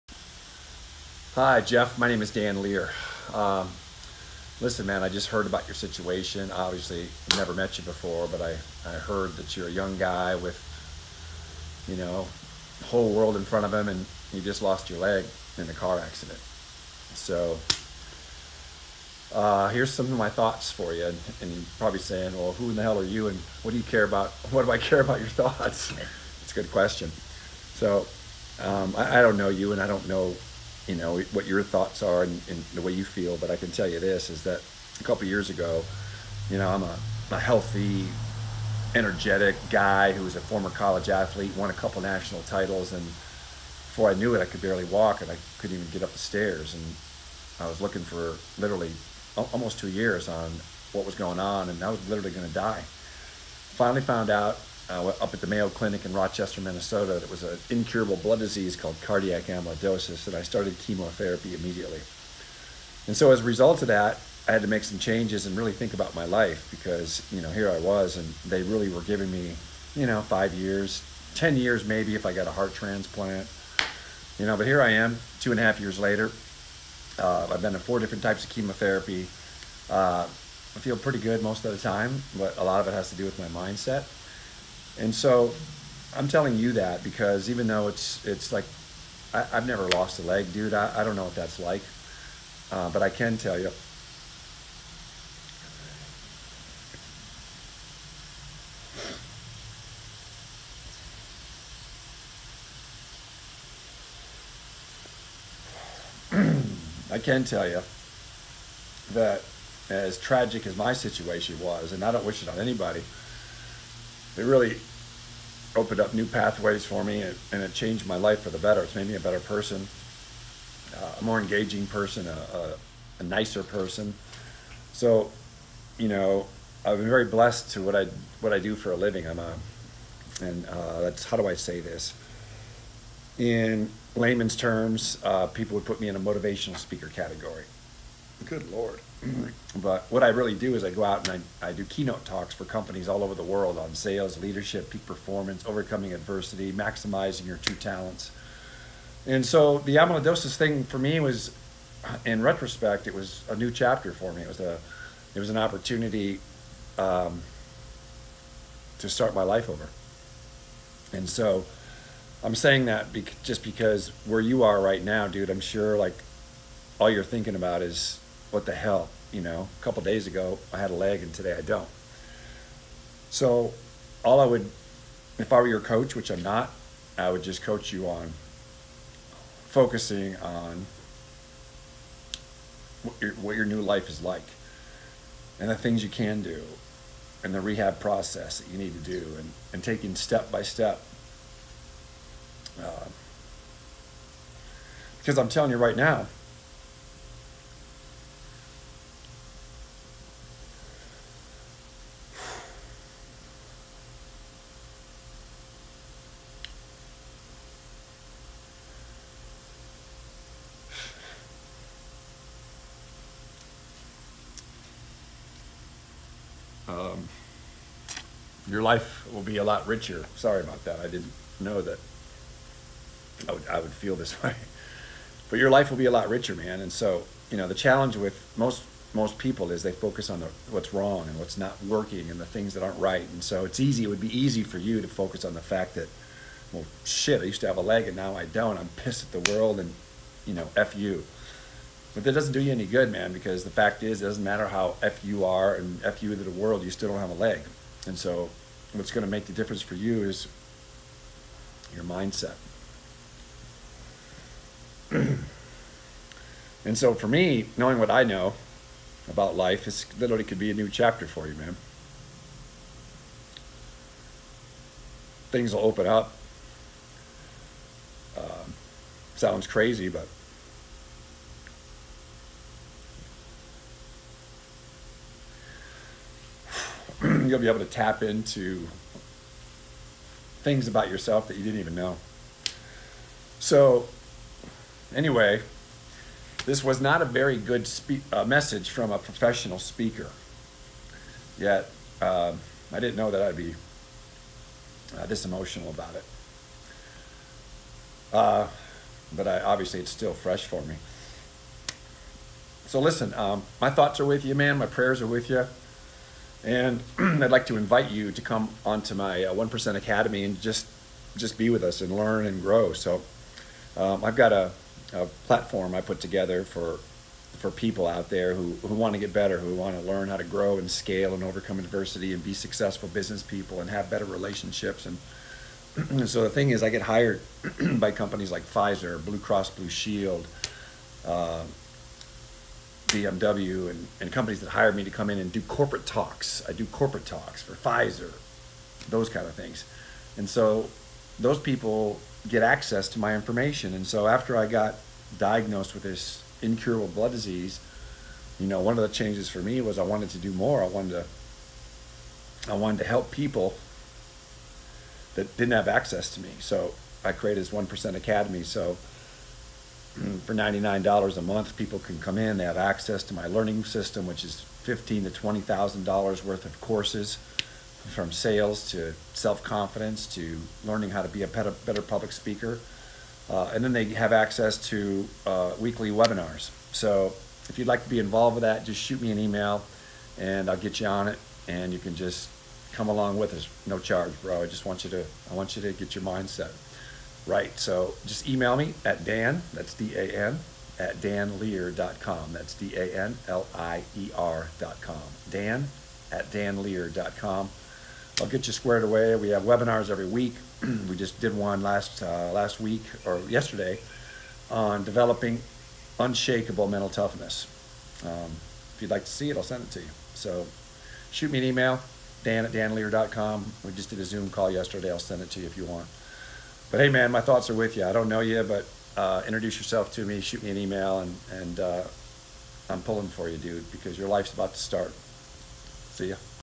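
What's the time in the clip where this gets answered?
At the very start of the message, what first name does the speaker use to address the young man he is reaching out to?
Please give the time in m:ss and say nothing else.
0:01.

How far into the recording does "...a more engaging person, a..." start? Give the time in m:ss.
2:01.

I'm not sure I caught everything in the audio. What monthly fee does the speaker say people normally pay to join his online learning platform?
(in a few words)
$99.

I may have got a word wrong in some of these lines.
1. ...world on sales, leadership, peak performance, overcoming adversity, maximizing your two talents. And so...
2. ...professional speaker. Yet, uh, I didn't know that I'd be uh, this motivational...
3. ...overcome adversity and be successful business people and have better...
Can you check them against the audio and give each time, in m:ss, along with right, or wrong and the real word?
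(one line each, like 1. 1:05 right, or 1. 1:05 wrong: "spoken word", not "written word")
1. 2:23 right
2. 4:49 wrong: "emotional", not "motivational"
3. 5:21 right.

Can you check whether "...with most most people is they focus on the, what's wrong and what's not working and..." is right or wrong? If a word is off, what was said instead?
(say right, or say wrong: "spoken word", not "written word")
right.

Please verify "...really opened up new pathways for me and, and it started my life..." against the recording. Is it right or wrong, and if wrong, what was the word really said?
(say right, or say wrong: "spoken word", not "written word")
wrong: "changed", not "started".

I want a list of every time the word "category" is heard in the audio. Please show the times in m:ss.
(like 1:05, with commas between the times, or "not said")
2:17.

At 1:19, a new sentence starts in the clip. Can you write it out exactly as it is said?
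Uh, I feel pretty good most of the time, but a lot of it has to do with my mindset.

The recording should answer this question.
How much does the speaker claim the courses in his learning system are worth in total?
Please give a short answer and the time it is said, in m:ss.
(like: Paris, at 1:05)
$15,000 to $20,000, at 6:04.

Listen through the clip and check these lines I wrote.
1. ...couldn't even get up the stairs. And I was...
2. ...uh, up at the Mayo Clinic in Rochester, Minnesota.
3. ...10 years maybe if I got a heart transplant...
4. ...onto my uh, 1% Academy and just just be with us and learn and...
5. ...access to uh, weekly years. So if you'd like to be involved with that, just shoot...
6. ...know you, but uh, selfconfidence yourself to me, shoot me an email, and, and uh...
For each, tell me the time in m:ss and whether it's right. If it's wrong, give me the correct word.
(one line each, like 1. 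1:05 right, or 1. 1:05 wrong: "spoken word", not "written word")
1. 0:45 right
2. 0:54 right
3. 1:11 right
4. 5:08 right
5. 6:14 wrong: "webinars", not "years"
6. 6:58 wrong: "introduce", not "selfconfidence".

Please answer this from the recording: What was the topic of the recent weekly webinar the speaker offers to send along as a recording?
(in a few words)
developing unshakable mental toughness.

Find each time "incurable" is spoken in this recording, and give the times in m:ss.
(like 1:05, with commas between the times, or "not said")
0:57, 5:46.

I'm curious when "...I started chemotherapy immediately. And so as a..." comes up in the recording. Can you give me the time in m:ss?
1:00.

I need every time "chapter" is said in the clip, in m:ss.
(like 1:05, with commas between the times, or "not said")
2:33, 4:20.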